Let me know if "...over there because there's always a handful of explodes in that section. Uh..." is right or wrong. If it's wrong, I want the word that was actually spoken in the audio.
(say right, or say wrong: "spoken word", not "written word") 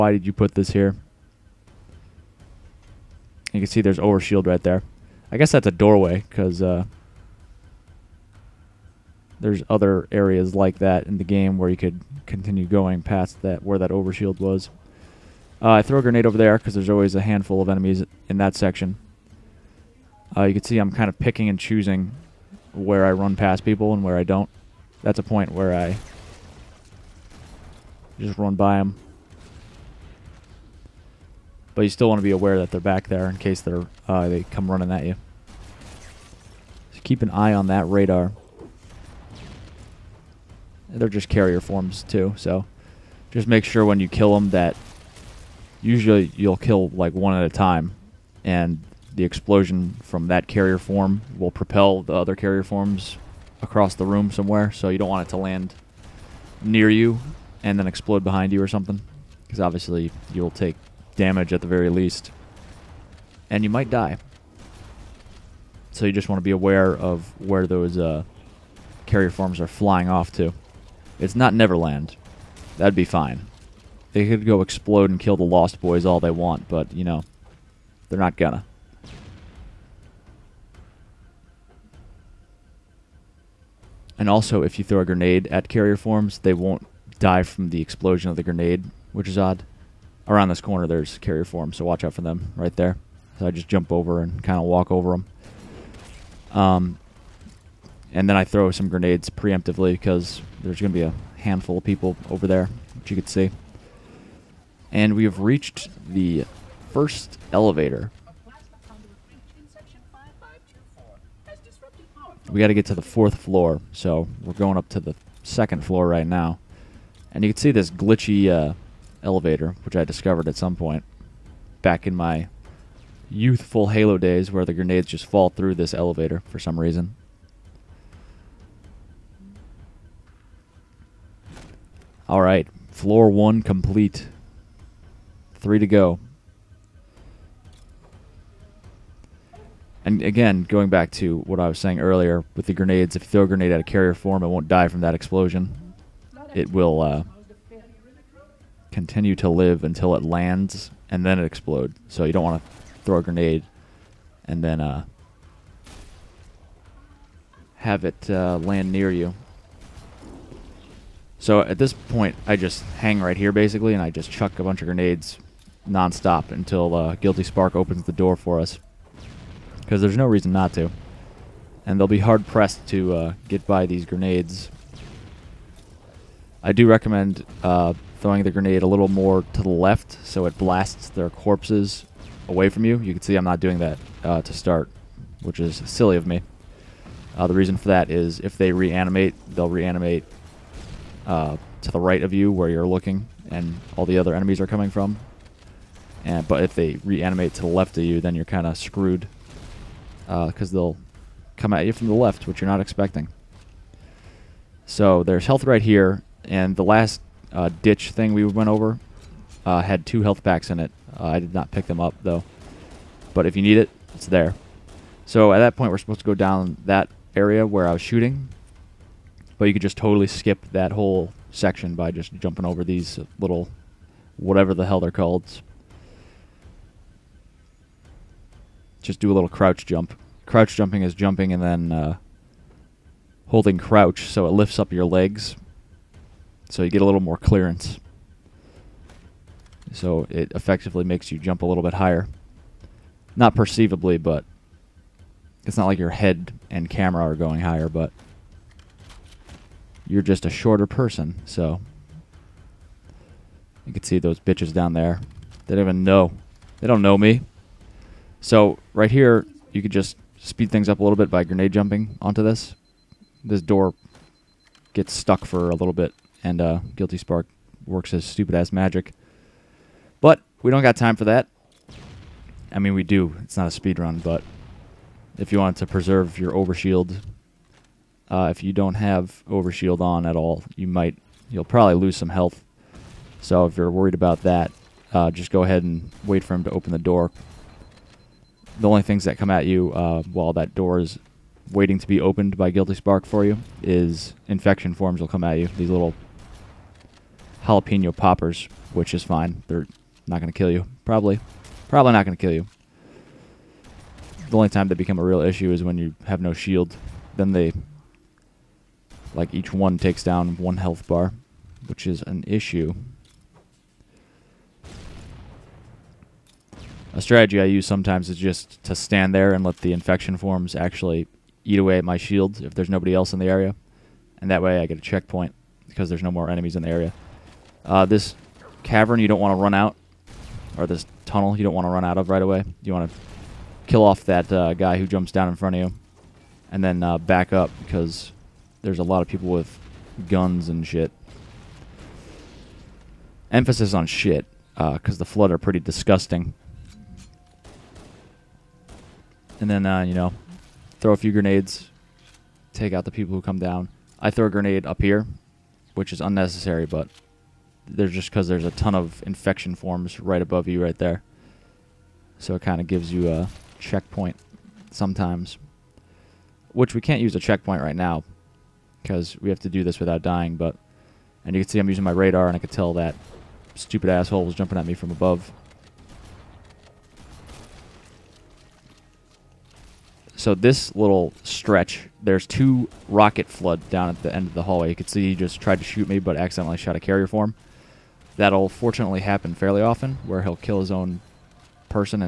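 wrong: "enemies", not "explodes".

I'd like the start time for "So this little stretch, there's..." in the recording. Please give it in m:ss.
6:20.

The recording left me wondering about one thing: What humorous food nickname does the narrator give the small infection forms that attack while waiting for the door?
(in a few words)
Jalapeno poppers.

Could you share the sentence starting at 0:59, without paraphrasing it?
Because obviously you'll take damage at the very least.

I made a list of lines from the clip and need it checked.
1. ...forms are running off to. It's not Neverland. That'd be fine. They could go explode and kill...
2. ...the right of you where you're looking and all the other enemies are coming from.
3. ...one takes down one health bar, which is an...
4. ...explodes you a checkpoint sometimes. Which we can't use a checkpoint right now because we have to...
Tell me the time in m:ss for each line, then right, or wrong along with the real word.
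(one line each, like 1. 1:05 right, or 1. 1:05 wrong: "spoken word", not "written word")
1. 1:09 wrong: "flying", not "running"
2. 3:11 right
3. 5:09 right
4. 6:02 wrong: "gives", not "explodes".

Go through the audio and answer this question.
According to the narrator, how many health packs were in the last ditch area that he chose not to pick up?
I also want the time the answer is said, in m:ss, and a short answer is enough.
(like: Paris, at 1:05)
2, at 3:30.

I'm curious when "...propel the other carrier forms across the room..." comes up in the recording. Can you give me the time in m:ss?
0:51.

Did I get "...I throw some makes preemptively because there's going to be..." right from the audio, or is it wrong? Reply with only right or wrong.
wrong.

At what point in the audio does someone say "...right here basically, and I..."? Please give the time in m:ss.
2:43.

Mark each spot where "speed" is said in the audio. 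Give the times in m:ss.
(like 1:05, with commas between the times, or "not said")
4:20, 4:33.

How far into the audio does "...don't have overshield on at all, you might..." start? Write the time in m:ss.
4:38.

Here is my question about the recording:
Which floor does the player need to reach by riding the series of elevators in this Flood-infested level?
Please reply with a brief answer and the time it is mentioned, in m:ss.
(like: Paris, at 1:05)
Fourth floor, at 1:53.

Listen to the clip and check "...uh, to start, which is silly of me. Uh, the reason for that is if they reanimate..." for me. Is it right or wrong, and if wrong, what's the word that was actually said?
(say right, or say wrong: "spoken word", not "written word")
right.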